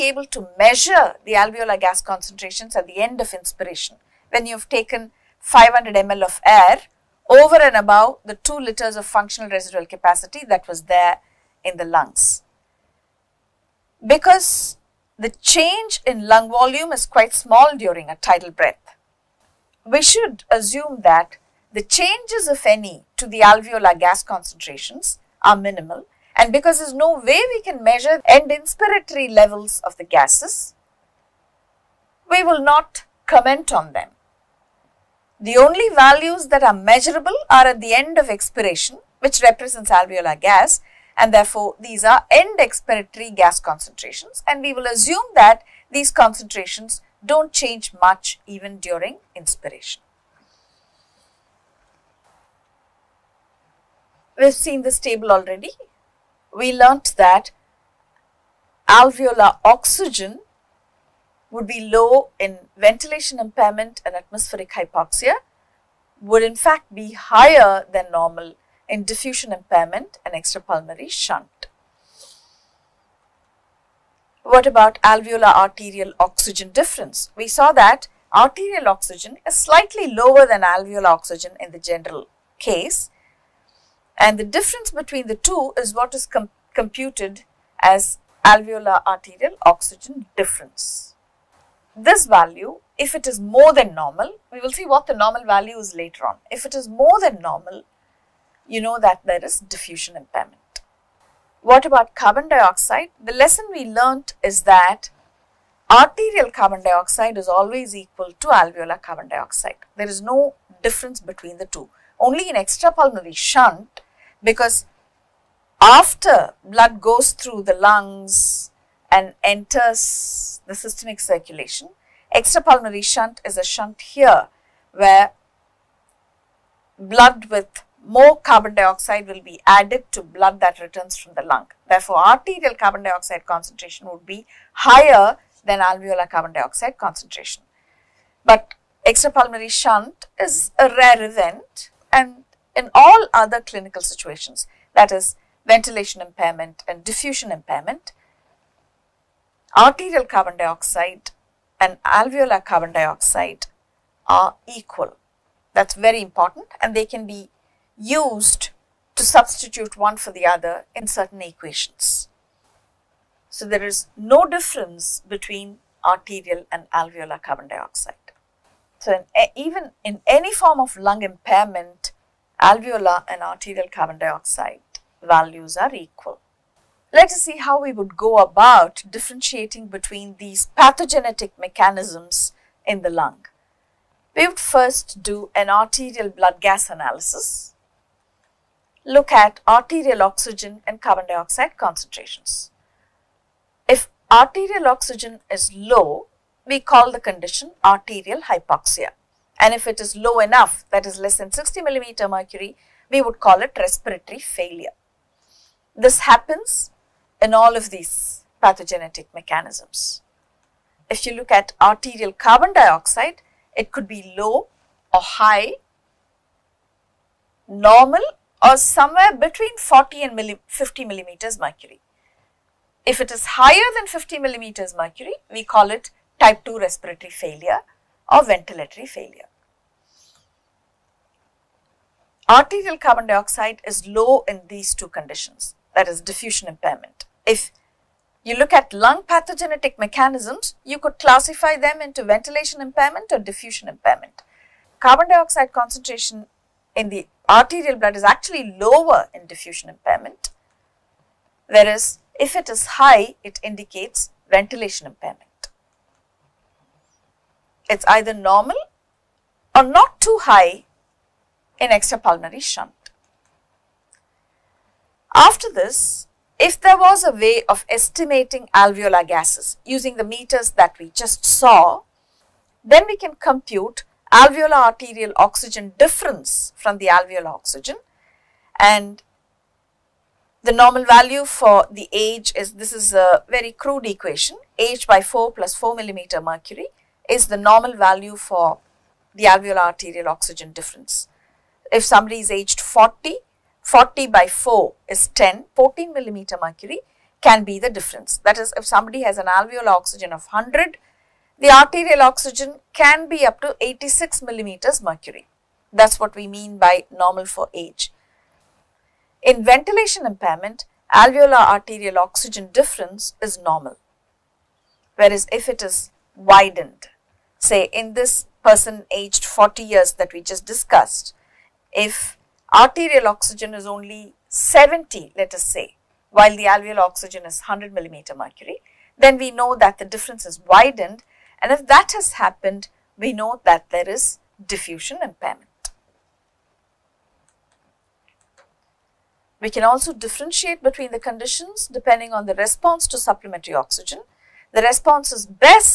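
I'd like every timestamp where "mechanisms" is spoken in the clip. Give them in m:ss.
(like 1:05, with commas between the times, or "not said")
3:01, 3:29, 3:59.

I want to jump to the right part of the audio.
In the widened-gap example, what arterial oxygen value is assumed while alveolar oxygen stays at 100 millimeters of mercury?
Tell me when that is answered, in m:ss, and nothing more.
5:24.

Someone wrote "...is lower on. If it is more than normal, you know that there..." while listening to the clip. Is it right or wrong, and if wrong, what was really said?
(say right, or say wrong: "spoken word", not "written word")
wrong: "later", not "lower".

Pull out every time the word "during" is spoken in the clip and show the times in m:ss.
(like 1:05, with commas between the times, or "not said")
0:17, 0:48.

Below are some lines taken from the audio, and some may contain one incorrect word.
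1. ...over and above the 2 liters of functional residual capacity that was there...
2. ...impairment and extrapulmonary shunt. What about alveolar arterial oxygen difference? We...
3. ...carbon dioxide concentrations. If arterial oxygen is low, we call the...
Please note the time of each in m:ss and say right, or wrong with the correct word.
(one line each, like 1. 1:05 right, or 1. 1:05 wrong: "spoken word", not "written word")
1. 0:07 right
2. 1:09 right
3. 3:11 right.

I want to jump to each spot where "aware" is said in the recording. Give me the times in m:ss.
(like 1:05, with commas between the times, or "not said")
not said.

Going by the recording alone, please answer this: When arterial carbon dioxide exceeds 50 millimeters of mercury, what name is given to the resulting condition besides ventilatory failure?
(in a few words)
type 2 respiratory failure.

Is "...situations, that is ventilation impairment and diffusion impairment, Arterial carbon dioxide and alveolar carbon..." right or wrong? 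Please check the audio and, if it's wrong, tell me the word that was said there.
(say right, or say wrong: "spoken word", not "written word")
right.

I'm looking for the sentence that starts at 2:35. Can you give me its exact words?
That's very important and they can be used to substitute one for the other in certain equations.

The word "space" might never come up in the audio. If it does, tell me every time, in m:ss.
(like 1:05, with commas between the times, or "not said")
not said.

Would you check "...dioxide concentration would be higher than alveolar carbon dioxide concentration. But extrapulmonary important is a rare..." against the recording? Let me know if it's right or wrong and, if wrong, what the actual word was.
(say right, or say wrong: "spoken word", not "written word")
wrong: "shunt", not "important".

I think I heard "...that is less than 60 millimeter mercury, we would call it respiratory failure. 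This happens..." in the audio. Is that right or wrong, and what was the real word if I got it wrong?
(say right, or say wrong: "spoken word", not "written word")
right.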